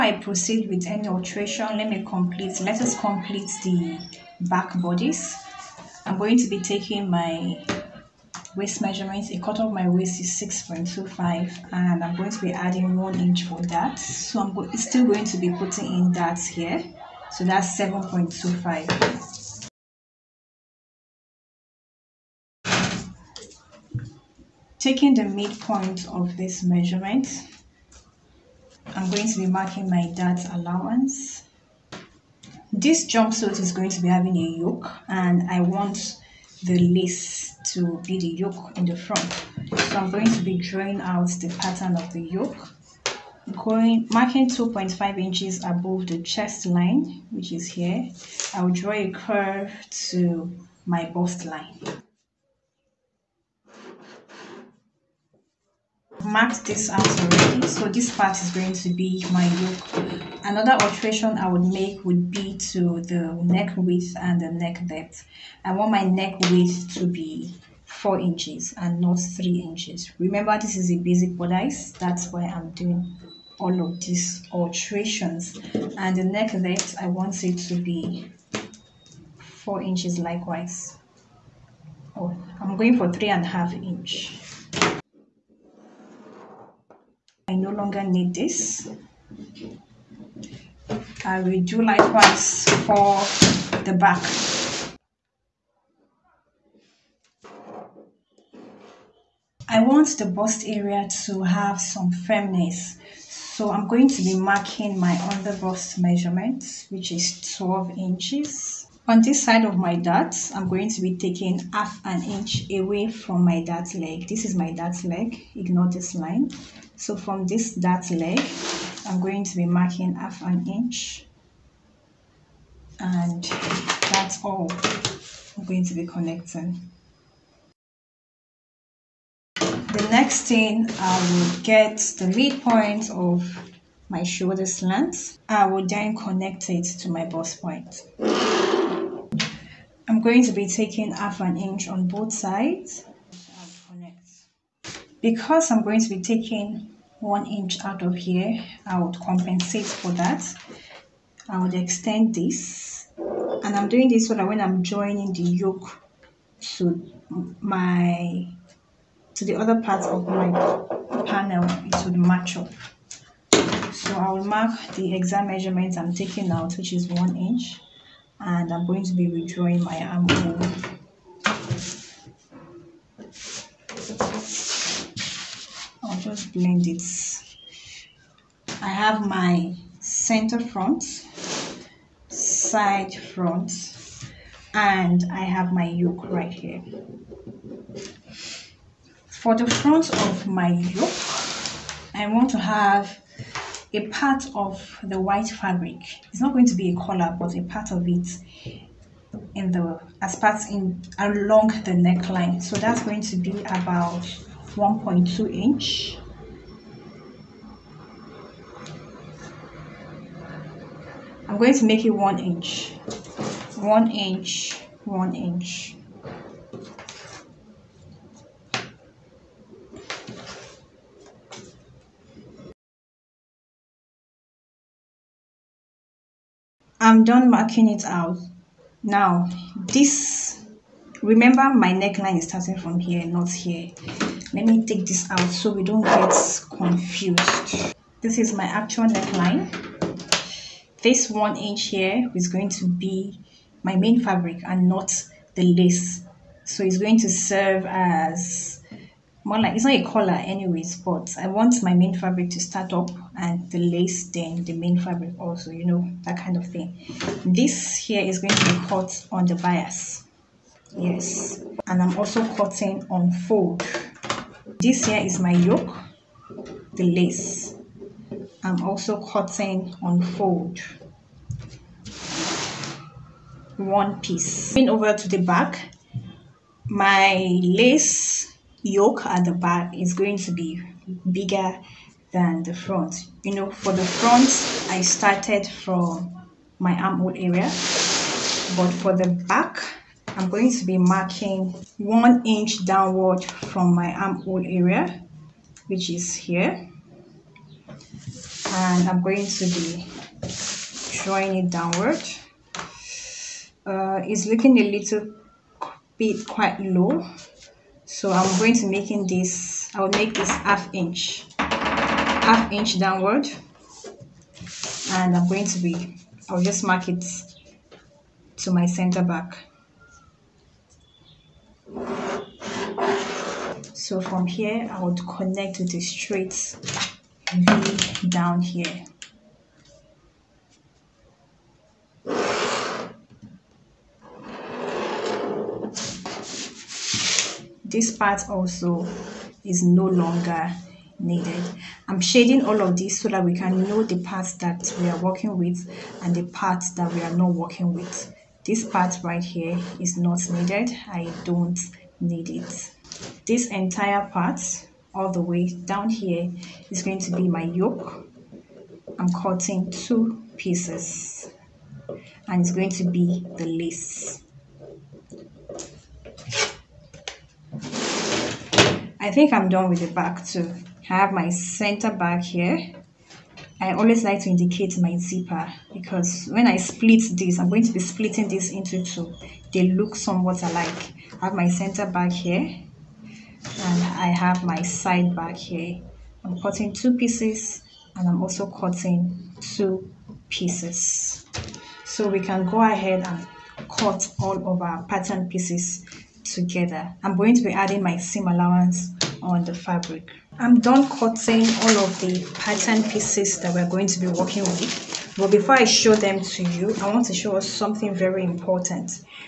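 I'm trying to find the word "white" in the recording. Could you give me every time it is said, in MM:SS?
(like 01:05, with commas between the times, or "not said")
03:15.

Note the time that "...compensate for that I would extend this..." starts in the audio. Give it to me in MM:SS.
02:29.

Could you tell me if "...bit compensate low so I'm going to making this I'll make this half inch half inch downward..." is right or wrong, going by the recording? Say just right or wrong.
wrong.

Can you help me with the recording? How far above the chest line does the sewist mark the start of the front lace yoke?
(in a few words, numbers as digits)
2.5 inches.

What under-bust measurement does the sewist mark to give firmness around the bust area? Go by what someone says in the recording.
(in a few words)
12 inches.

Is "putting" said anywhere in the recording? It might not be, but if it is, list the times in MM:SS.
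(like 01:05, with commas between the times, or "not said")
00:15.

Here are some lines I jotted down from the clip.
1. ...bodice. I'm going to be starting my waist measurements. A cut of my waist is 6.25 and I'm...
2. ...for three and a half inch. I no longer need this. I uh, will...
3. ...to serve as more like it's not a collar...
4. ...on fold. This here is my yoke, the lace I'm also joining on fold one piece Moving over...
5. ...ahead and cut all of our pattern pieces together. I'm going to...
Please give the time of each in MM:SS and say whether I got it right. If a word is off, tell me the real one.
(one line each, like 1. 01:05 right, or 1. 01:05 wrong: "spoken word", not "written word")
1. 00:04 wrong: "taking", not "starting"
2. 01:22 right
3. 04:07 right
4. 04:23 wrong: "cutting", not "joining"
5. 06:32 right.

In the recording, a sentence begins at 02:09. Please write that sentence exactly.
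The next thing I will get the midpoint of my shoulder slant.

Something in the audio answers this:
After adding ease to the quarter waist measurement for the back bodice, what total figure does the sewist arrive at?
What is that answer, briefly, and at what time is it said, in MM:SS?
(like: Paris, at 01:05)
7.25, at 00:17.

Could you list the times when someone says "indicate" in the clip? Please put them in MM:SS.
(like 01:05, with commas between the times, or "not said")
06:14.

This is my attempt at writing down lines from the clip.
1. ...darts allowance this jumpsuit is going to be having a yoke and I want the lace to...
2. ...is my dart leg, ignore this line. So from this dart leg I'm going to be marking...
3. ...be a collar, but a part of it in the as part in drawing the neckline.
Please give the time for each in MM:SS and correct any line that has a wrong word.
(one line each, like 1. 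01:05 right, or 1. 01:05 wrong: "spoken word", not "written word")
1. 00:30 right
2. 01:54 right
3. 03:16 wrong: "along", not "drawing".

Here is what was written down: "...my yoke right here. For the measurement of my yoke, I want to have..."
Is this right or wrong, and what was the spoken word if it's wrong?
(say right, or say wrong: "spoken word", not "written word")
wrong: "front", not "measurement".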